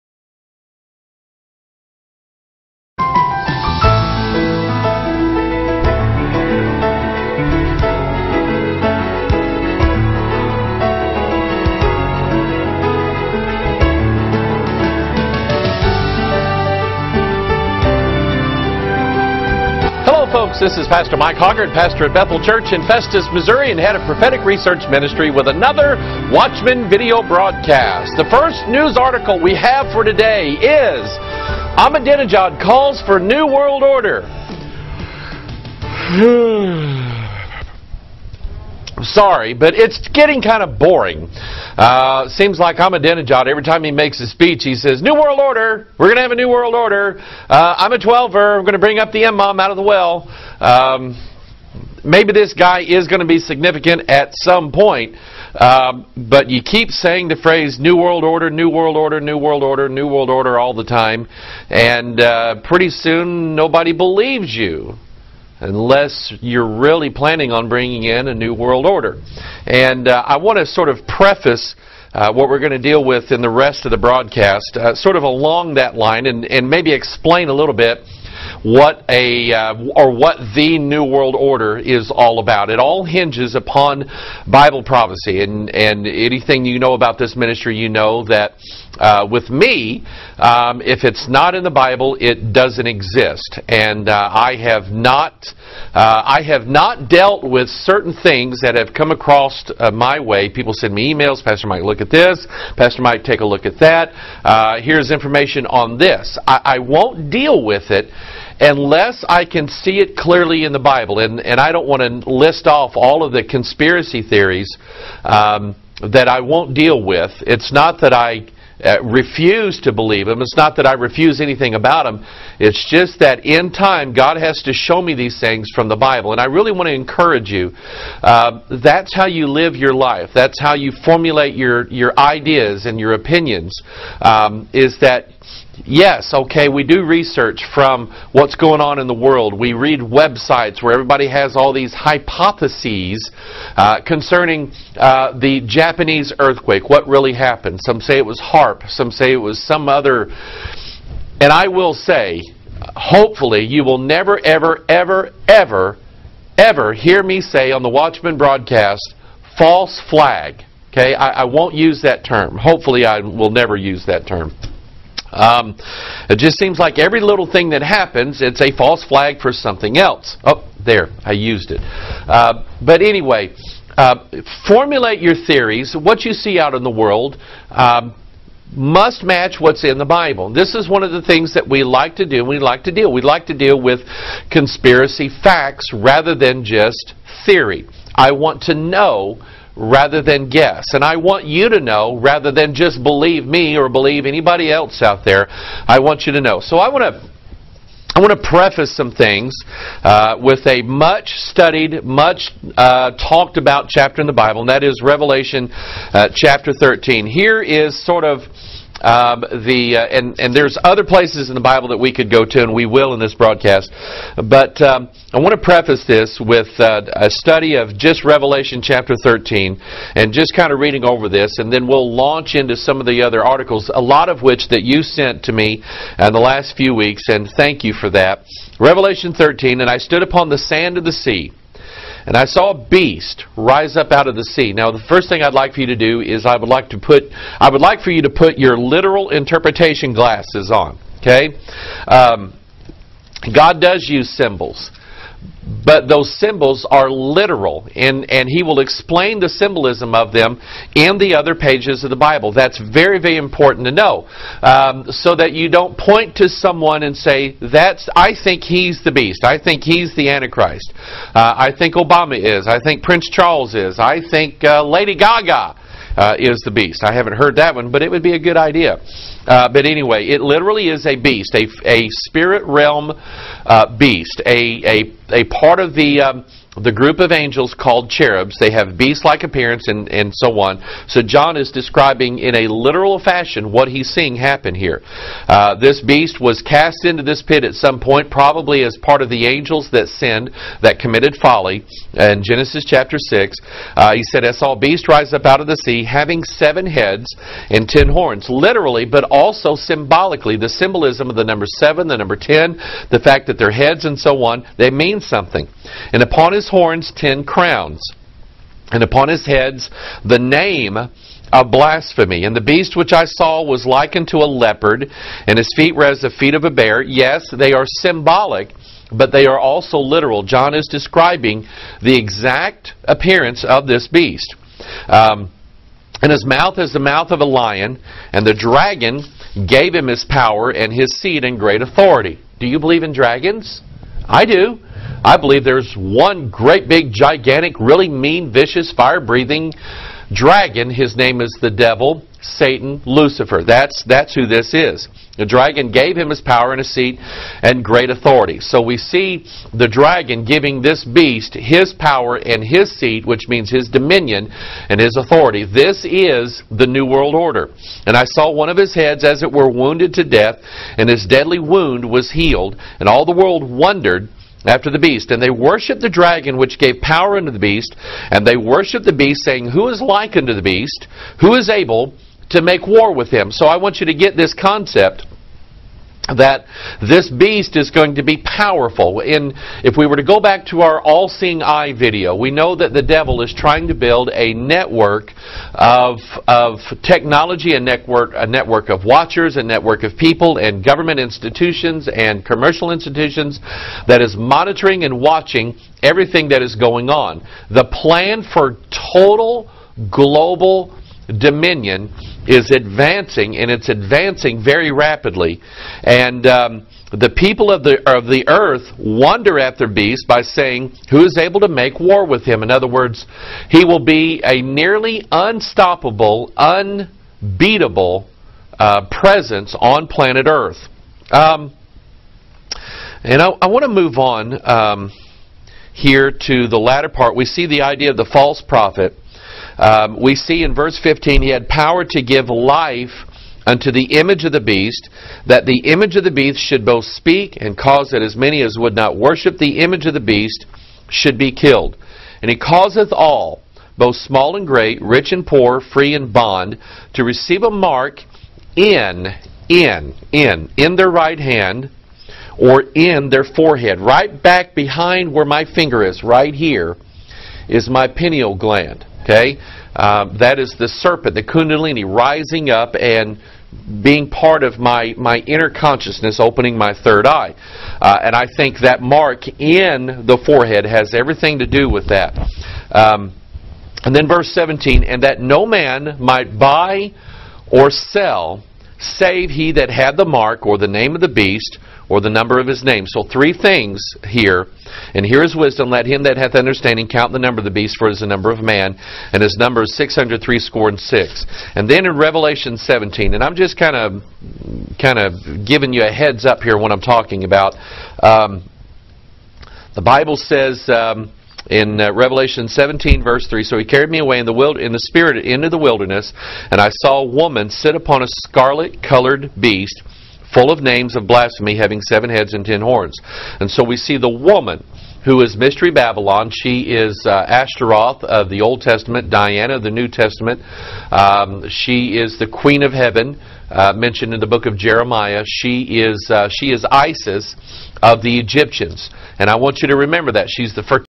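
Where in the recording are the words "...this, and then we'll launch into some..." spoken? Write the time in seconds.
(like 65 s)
221 s.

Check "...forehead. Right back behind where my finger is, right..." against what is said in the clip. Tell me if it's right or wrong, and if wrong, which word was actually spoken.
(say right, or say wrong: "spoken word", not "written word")
right.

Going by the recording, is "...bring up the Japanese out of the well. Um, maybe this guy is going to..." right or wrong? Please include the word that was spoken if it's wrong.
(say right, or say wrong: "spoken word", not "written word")
wrong: "Imam", not "Japanese".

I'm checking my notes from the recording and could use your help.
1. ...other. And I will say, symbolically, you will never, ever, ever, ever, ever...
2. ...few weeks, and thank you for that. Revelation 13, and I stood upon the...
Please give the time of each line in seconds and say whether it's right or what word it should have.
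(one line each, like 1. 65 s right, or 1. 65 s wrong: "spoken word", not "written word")
1. 149 s wrong: "hopefully", not "symbolically"
2. 226 s right.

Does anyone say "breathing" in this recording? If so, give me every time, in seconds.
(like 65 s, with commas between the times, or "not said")
338 s.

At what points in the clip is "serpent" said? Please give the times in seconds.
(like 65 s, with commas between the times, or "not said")
460 s.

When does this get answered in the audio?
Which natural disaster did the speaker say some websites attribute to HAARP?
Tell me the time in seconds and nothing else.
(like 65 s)
145 s.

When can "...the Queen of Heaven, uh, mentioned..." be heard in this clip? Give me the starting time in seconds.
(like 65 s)
522 s.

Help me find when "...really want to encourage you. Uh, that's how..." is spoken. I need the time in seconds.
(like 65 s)
126 s.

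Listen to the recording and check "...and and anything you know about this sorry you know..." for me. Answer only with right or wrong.
wrong.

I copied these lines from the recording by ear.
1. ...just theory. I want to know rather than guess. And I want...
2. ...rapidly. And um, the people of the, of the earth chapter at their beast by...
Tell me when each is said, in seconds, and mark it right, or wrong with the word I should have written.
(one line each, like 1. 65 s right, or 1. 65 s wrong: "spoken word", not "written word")
1. 186 s right
2. 404 s wrong: "wonder", not "chapter".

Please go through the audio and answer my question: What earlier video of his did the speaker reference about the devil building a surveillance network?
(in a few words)
All-seeing eye video.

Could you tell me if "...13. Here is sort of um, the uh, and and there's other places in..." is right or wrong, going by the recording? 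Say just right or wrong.
right.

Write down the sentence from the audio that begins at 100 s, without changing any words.
People send me emails, Pastor Mike, look at this.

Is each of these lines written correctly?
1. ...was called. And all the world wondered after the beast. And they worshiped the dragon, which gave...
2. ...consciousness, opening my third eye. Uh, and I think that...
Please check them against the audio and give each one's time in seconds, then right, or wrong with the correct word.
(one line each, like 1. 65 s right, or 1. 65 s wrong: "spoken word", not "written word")
1. 362 s wrong: "healed", not "called"
2. 465 s right.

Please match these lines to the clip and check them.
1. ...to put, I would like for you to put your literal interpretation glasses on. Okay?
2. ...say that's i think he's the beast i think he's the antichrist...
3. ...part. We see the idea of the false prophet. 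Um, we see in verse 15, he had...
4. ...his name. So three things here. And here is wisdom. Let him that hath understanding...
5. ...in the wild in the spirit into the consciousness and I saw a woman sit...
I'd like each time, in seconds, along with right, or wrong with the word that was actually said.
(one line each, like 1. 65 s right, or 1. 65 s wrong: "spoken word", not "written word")
1. 236 s right
2. 257 s right
3. 427 s right
4. 482 s right
5. 504 s wrong: "wilderness", not "consciousness".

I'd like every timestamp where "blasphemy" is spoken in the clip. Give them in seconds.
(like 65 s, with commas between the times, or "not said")
311 s, 511 s.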